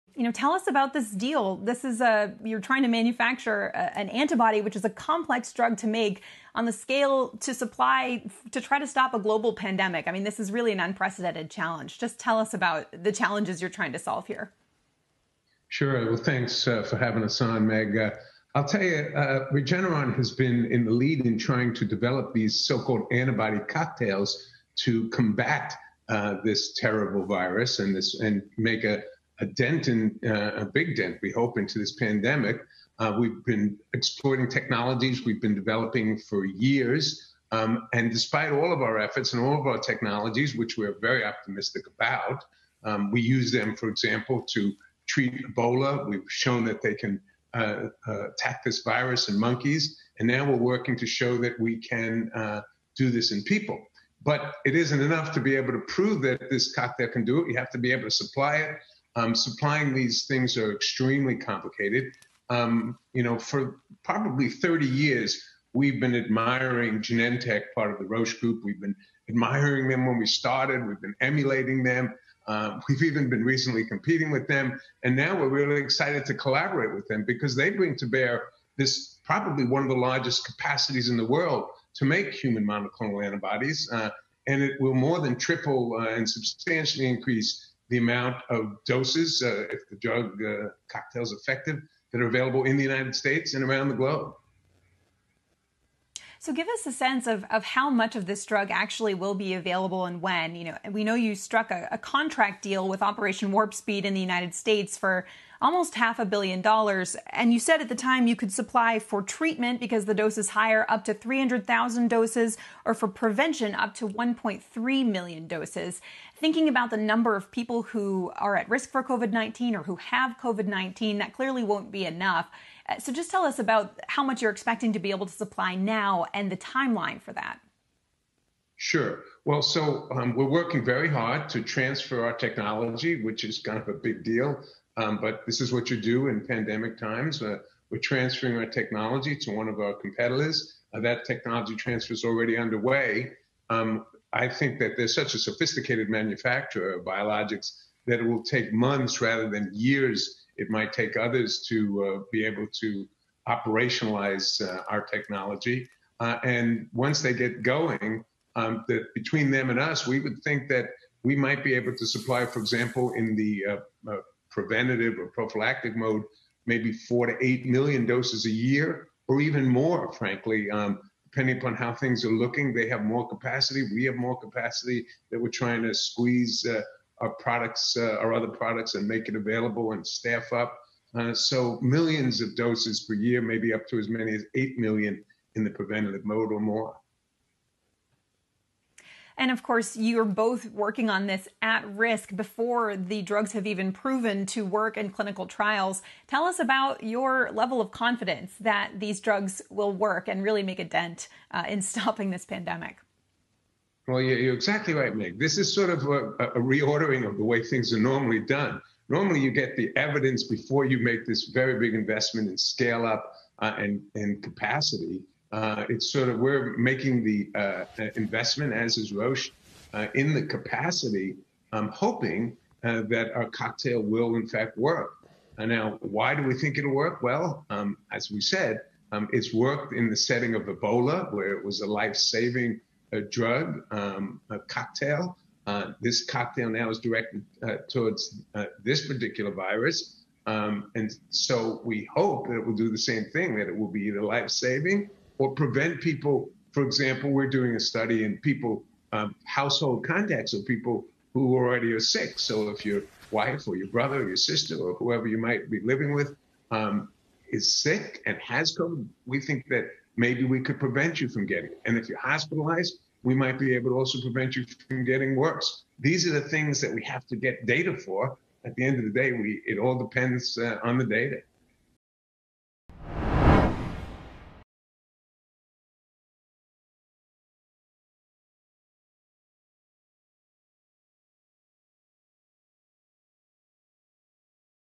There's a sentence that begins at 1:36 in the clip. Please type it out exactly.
So give us a sense of, of how much of this drug actually will be available and when.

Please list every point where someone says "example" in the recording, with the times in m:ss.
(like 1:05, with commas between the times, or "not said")
0:43, 2:42, 4:06.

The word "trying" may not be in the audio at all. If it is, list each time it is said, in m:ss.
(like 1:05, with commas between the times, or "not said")
0:02, 0:13, 0:21, 2:55.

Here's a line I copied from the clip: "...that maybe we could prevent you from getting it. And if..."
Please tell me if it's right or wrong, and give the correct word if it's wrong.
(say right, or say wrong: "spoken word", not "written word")
right.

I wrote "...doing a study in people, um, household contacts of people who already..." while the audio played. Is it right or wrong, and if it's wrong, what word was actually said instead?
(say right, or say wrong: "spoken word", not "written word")
right.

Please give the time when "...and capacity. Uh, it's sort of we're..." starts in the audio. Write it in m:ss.
3:34.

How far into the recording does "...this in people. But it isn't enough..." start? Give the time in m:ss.
0:53.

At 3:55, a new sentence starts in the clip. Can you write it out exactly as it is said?
this cocktail now is directed towards this particular virus.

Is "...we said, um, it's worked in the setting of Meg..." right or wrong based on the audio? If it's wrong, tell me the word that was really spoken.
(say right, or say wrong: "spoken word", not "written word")
wrong: "Ebola", not "Meg".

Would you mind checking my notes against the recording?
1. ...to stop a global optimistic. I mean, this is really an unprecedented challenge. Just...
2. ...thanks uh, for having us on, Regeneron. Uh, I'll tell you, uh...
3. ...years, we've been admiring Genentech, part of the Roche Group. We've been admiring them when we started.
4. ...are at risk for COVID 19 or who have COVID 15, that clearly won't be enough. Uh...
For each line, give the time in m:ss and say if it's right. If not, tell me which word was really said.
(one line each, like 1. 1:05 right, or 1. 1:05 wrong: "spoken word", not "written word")
1. 0:08 wrong: "pandemic", not "optimistic"
2. 0:16 wrong: "Meg", not "Regeneron"
3. 1:04 right
4. 1:58 wrong: "19", not "15".